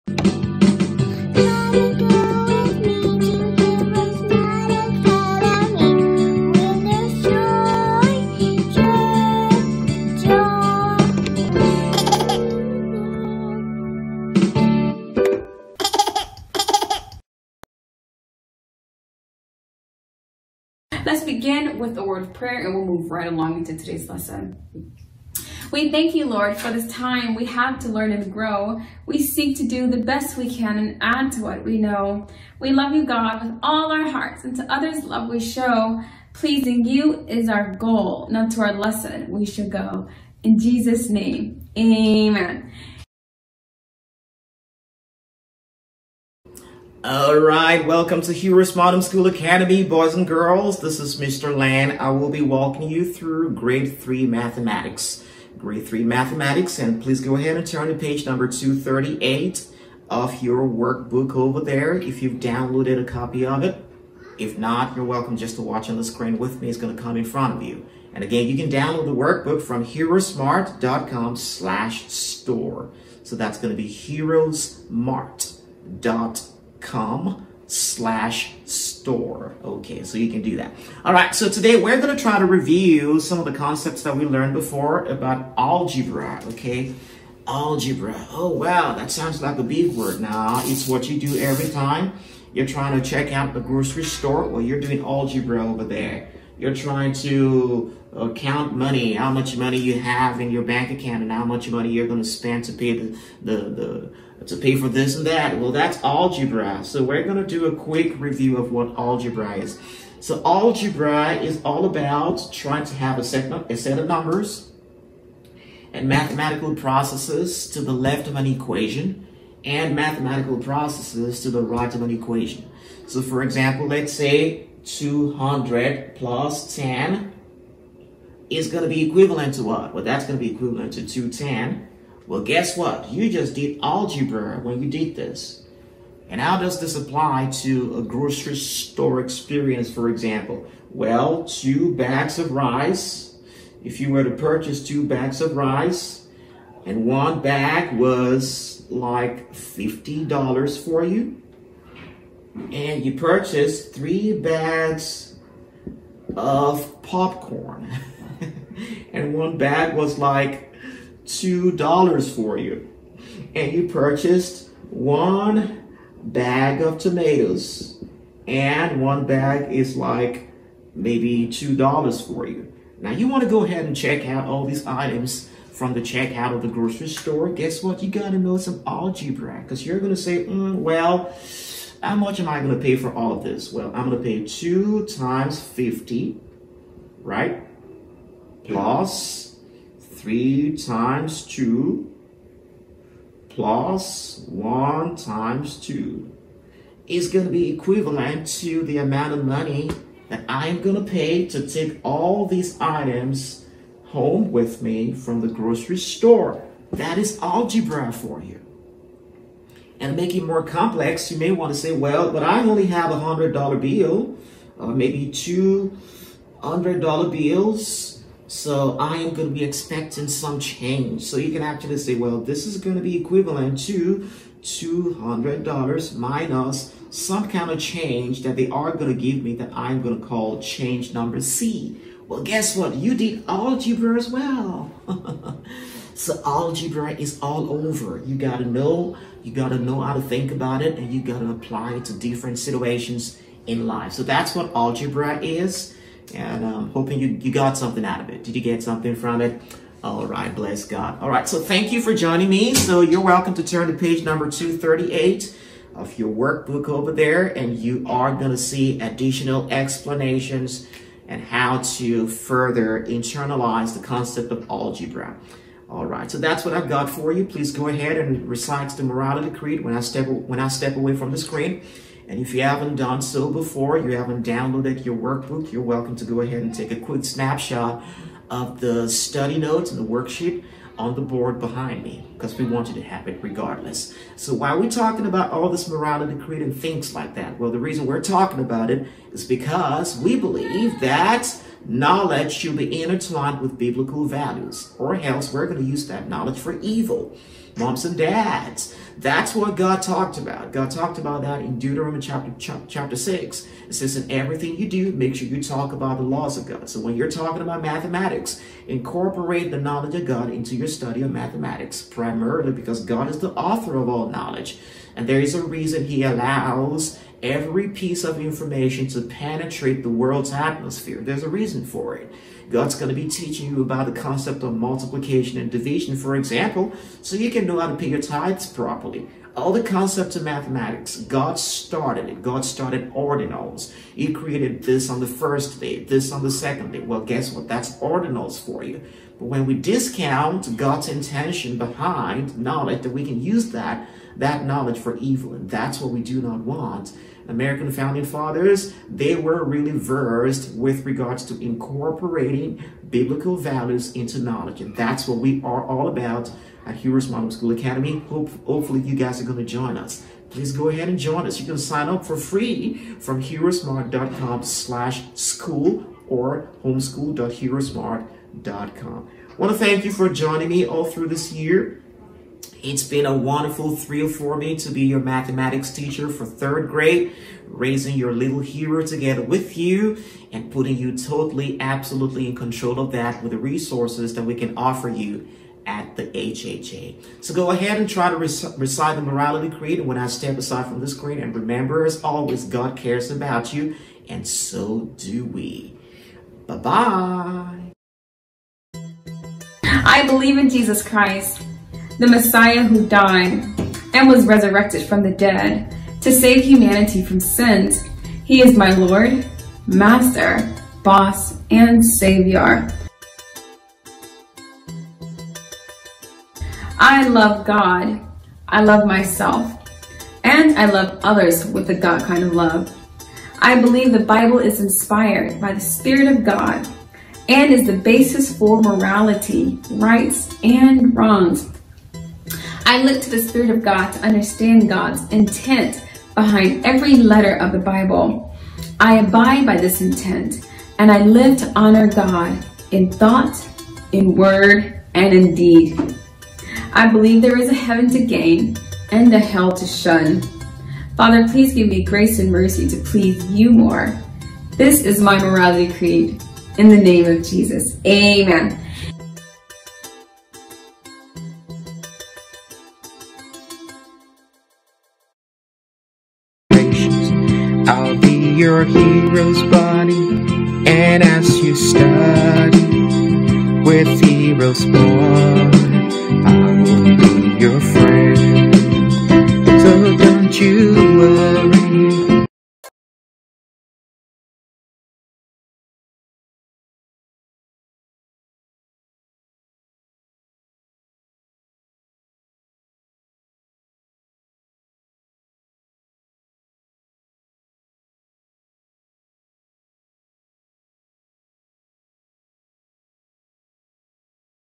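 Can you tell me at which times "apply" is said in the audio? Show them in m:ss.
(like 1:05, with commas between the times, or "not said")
2:16, 4:01.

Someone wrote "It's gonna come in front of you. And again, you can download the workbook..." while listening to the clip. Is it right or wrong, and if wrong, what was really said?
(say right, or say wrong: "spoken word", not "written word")
right.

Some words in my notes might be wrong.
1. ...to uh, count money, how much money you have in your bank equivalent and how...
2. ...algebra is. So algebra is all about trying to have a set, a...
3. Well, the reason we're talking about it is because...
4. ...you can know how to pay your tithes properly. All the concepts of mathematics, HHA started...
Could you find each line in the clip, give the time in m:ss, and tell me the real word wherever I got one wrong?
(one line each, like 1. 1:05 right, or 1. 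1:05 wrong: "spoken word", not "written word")
1. 1:37 wrong: "account", not "equivalent"
2. 1:48 right
3. 4:47 right
4. 5:27 wrong: "God", not "HHA".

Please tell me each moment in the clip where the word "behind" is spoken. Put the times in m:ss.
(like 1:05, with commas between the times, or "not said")
4:41, 5:41, 7:16.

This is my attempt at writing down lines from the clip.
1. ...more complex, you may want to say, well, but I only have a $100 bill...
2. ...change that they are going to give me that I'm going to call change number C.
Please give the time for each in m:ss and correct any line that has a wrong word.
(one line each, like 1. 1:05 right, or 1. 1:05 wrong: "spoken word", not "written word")
1. 3:30 right
2. 3:47 right.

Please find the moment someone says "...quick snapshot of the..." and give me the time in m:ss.
4:36.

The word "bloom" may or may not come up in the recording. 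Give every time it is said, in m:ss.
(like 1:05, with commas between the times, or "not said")
not said.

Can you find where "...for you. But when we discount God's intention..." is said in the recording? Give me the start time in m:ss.
5:38.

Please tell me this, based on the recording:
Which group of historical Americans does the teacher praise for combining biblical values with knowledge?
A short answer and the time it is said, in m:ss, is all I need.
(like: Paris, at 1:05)
American founding fathers, at 5:47.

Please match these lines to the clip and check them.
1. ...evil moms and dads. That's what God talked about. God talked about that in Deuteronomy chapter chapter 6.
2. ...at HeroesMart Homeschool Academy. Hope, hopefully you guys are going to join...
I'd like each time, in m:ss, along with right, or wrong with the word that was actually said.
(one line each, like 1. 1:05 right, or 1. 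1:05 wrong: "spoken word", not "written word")
1. 4:56 right
2. 5:56 right.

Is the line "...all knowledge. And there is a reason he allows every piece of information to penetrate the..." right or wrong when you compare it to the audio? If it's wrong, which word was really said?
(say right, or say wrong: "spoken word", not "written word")
right.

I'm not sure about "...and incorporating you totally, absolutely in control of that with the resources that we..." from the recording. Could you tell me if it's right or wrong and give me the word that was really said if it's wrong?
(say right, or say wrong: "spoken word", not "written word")
wrong: "putting", not "incorporating".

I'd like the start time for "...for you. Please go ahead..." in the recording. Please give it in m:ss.
4:27.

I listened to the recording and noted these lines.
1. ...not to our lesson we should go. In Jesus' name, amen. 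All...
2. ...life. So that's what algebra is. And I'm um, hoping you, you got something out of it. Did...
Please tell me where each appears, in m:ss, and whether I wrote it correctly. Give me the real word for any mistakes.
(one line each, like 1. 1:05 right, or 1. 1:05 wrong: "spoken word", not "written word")
1. 0:38 right
2. 4:03 right.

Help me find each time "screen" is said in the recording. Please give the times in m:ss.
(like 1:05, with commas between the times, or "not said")
1:06, 4:31, 6:31.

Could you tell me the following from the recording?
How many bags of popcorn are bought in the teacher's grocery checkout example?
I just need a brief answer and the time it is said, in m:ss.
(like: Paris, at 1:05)
3, at 2:33.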